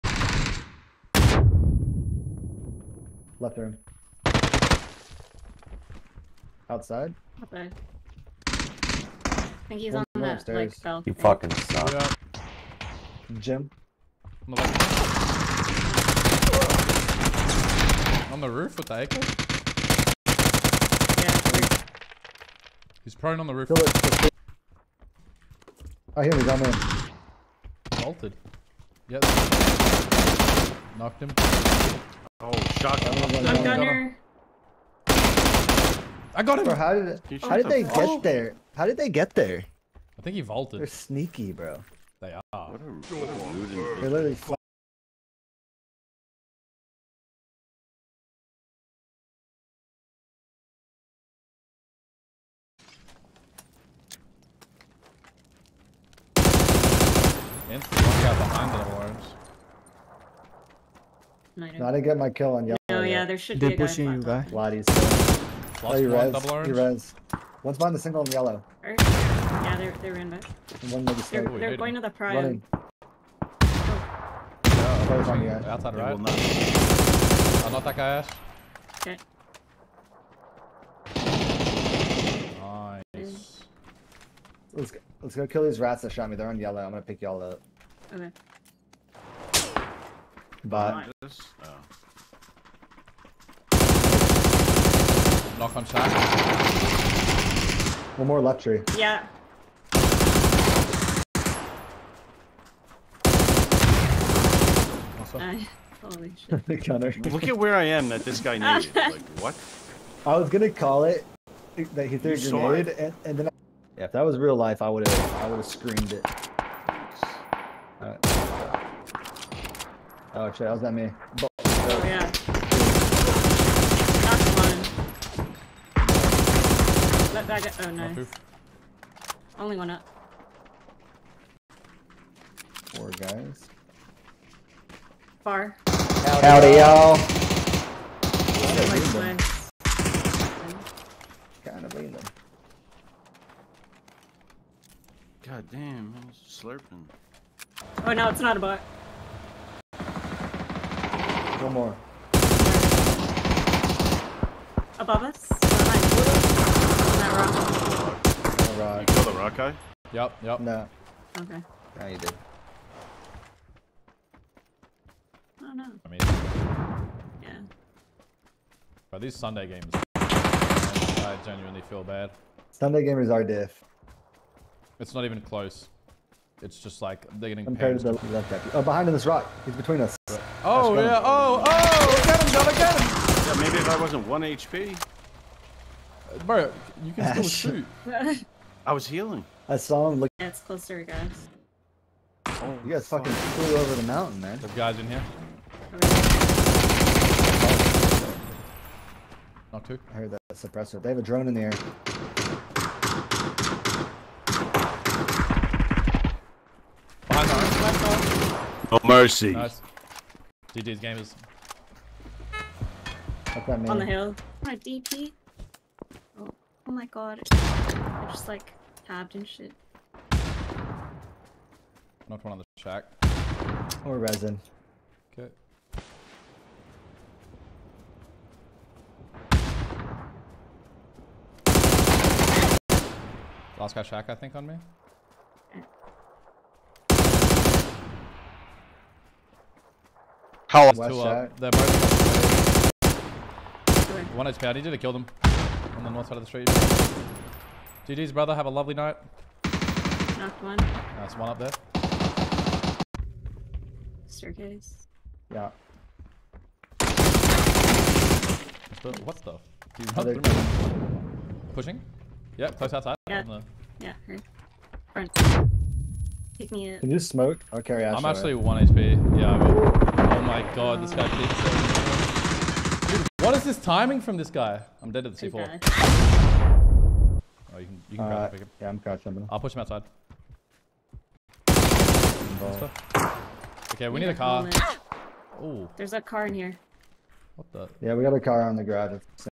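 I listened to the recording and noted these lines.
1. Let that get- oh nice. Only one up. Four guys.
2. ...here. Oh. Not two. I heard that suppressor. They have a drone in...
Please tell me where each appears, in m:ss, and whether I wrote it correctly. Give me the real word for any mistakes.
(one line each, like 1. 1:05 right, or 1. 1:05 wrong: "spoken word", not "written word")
1. 2:07 right
2. 3:15 right.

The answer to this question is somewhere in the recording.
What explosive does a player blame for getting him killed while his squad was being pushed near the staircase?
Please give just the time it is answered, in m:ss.
4:35.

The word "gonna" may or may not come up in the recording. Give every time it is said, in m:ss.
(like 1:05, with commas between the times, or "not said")
1:26, 1:50.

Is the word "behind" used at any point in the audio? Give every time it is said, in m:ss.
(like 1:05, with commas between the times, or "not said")
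0:57, 1:07, 2:35, 2:58.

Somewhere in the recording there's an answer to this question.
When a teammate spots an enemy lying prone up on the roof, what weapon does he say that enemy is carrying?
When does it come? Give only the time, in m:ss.
0:19.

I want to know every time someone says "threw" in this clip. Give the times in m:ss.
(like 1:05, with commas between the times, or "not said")
1:52.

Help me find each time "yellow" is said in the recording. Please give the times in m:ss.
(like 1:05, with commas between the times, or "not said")
1:02, 1:08, 1:26.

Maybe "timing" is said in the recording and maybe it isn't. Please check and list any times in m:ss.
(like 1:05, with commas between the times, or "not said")
4:33.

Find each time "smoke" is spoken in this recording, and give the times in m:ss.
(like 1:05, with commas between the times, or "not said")
4:27.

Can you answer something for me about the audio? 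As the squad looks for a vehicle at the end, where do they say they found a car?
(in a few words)
the garage.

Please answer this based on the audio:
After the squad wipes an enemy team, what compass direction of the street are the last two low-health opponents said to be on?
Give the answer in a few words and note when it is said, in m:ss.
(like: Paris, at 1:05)
north, at 4:06.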